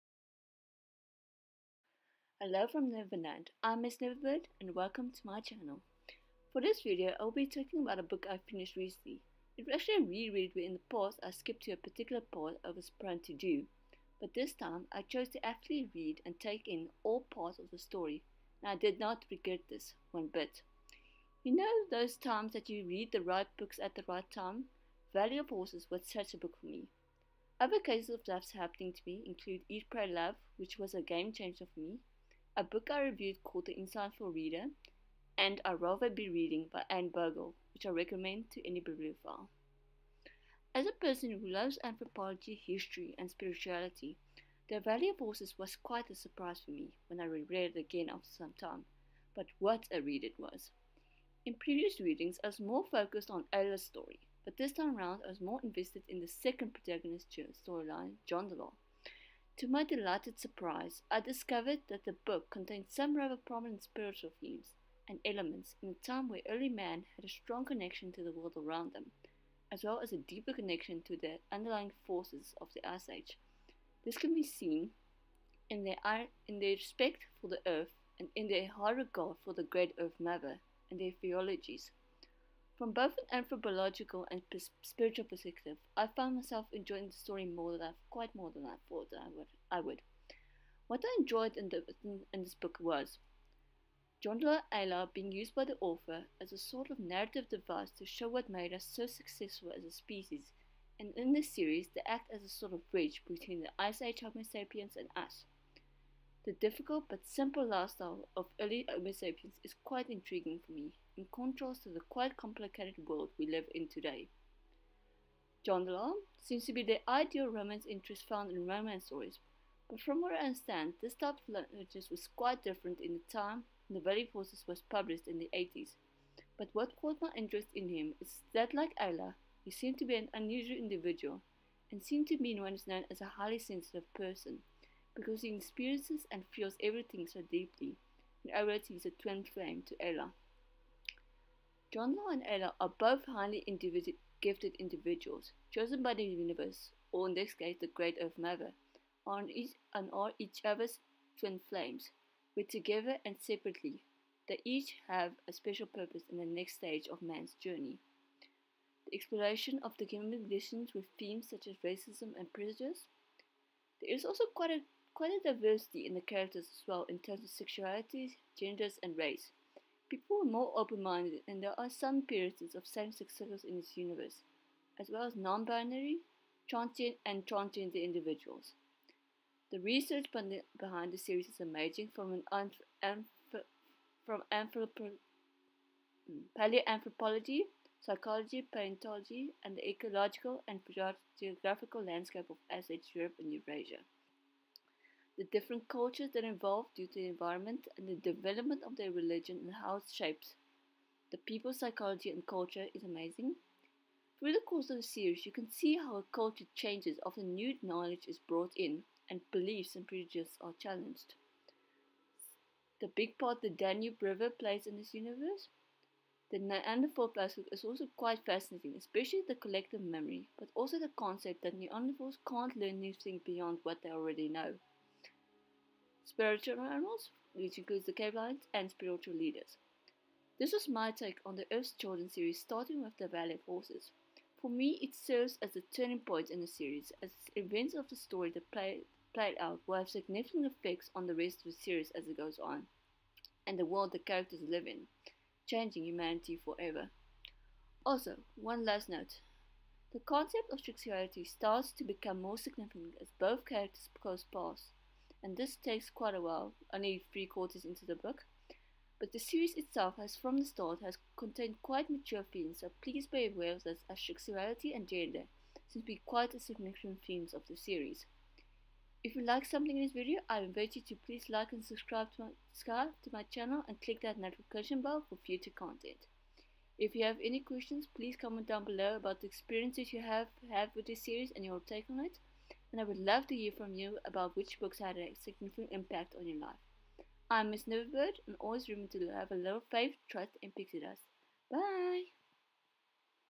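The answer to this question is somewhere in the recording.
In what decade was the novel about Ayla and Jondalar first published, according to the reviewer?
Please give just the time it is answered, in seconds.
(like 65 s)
125 s.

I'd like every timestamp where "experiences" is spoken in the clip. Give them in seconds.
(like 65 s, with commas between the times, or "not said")
135 s, 279 s.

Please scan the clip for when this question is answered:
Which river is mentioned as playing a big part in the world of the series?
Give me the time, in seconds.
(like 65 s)
213 s.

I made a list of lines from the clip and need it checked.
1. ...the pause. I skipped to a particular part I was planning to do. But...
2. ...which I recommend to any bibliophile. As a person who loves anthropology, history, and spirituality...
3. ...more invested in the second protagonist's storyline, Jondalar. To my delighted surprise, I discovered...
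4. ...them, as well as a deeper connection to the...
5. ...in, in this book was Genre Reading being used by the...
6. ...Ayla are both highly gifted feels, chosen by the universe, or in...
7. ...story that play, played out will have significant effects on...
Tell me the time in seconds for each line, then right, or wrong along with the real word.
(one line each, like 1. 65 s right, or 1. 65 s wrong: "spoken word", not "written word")
1. 10 s right
2. 37 s right
3. 55 s right
4. 68 s right
5. 92 s wrong: "Ayla", not "Reading"
6. 142 s wrong: "individuals", not "feels"
7. 238 s right.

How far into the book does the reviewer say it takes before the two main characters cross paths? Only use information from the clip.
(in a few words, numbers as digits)
three quarters.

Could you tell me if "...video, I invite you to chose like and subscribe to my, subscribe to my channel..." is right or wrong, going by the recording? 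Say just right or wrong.
wrong.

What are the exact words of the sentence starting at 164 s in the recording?
There is also quite a quite a diversity in the characters as well in terms of sexualities, genders, and race.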